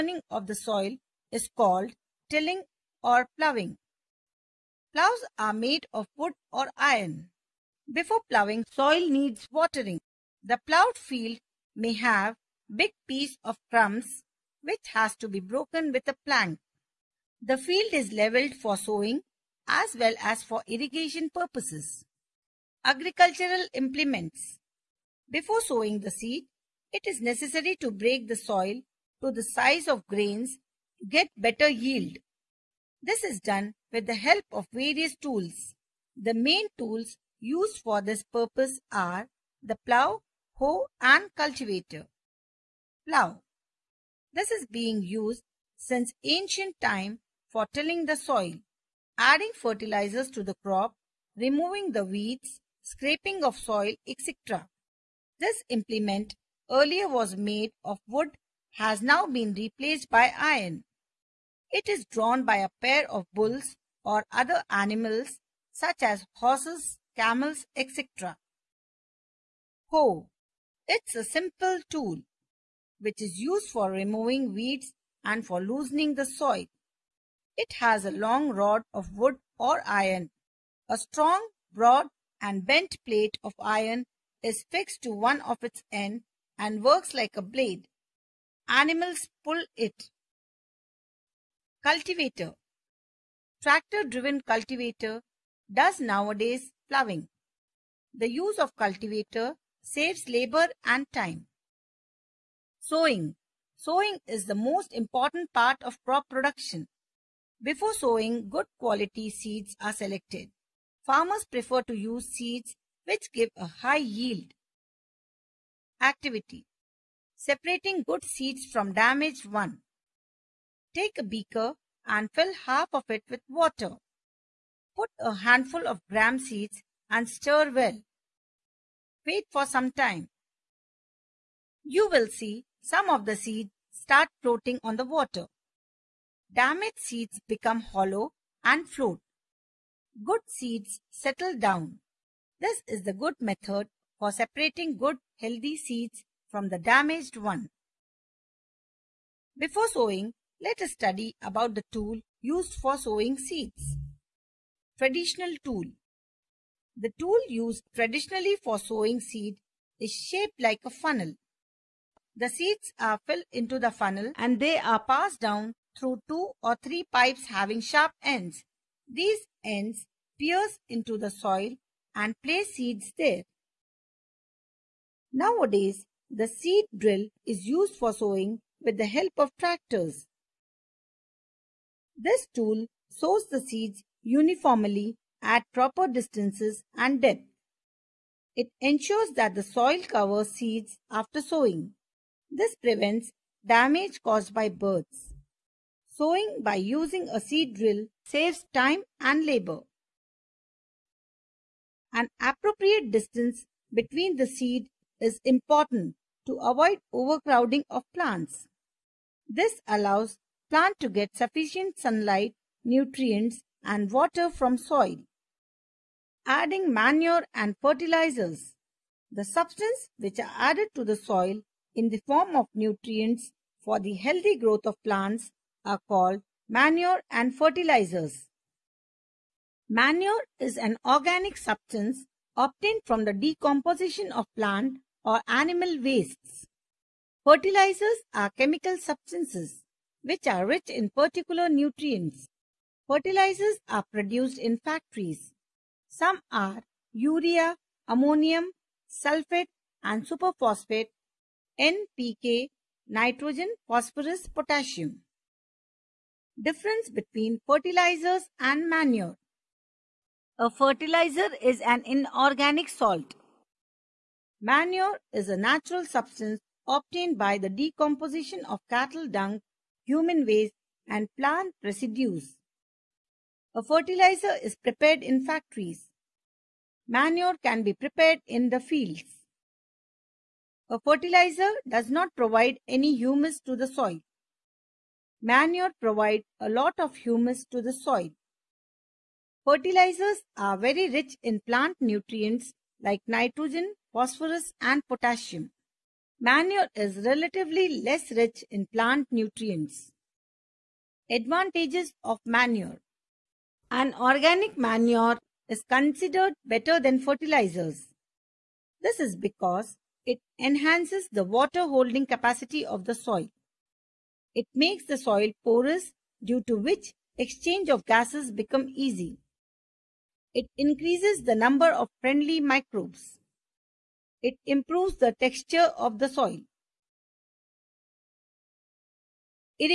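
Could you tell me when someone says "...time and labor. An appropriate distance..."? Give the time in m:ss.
3:18.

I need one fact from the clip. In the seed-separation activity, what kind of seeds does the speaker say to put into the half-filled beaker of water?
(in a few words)
Gram seeds.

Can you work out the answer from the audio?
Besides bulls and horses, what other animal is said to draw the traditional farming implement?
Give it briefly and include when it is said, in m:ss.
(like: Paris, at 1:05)
Camels, at 1:07.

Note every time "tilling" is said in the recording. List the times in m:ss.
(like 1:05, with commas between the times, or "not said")
0:02, 0:47.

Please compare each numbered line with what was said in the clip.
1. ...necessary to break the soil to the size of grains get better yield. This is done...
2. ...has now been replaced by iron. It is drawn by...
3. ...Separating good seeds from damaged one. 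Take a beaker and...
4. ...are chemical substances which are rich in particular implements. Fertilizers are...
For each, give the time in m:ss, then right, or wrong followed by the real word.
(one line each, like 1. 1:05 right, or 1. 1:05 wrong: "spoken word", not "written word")
1. 0:27 right
2. 0:58 right
3. 1:57 right
4. 3:58 wrong: "nutrients", not "implements".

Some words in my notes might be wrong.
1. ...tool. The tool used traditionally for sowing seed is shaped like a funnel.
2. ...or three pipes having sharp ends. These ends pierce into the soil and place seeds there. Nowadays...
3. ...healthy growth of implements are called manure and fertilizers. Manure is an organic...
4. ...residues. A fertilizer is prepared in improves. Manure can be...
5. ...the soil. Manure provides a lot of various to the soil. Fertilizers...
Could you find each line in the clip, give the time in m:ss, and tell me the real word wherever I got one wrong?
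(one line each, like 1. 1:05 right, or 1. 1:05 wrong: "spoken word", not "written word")
1. 2:35 right
2. 2:46 right
3. 3:44 wrong: "plants", not "implements"
4. 4:31 wrong: "factories", not "improves"
5. 4:43 wrong: "humus", not "various".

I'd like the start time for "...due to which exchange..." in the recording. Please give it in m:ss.
5:16.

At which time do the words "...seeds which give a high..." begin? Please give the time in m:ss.
1:52.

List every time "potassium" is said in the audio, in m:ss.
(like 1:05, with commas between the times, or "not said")
4:14, 4:55.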